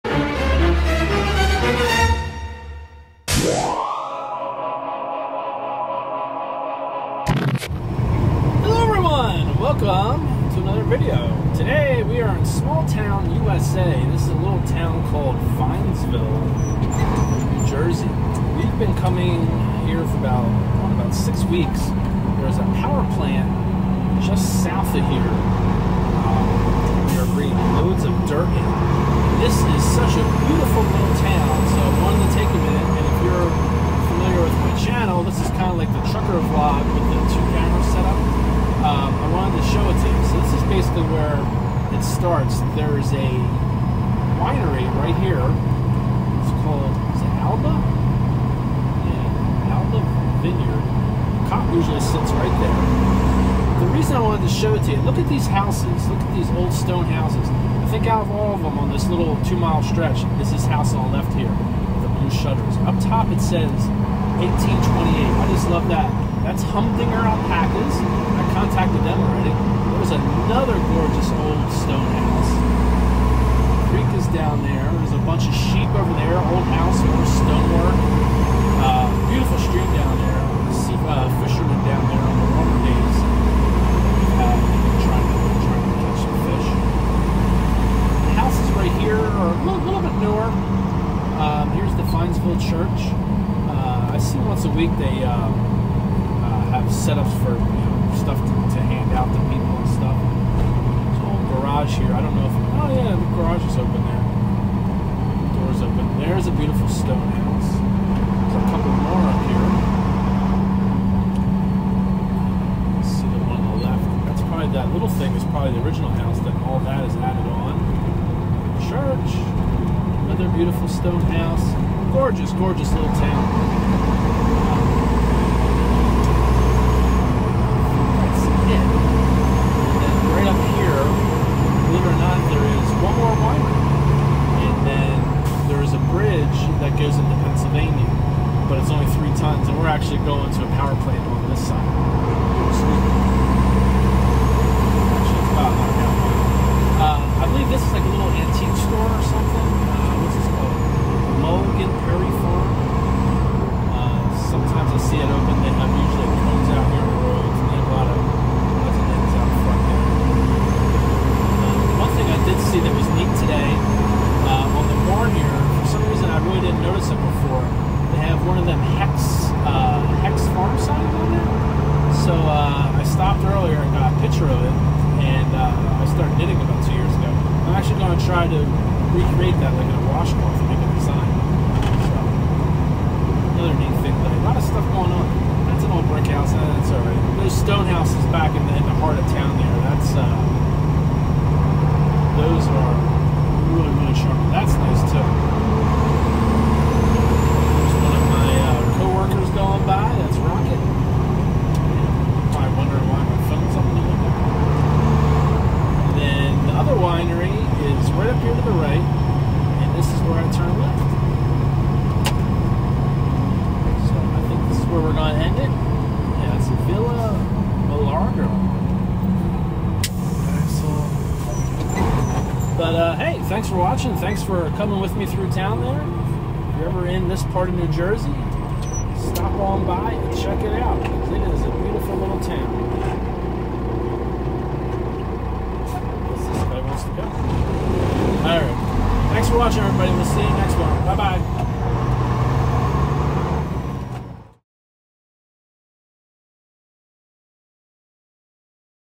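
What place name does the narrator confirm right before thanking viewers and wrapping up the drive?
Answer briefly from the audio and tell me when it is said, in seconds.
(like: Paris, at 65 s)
Villa Milagro, at 216 s.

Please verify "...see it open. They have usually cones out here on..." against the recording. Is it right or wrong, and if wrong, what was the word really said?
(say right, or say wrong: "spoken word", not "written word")
right.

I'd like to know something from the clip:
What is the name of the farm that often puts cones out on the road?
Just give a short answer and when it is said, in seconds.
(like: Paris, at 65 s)
Logan Prairie Farm, at 151 s.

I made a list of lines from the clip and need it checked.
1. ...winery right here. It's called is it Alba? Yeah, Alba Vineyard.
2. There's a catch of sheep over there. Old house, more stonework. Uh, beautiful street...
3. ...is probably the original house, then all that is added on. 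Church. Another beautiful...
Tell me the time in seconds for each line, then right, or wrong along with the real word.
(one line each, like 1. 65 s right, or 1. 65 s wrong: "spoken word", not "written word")
1. 44 s right
2. 74 s wrong: "bunch", not "catch"
3. 115 s right.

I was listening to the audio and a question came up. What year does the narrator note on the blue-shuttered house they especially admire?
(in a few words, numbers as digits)
1828.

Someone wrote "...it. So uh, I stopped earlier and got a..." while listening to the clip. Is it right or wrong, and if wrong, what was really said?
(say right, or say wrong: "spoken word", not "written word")
right.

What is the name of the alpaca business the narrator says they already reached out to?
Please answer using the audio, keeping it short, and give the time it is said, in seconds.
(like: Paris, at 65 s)
Humdinger Alpacas, at 66 s.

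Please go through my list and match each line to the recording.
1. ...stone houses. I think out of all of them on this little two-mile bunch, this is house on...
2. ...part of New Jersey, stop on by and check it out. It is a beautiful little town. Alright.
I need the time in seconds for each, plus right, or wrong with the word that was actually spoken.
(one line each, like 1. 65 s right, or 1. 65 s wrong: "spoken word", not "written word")
1. 56 s wrong: "stretch", not "bunch"
2. 227 s right.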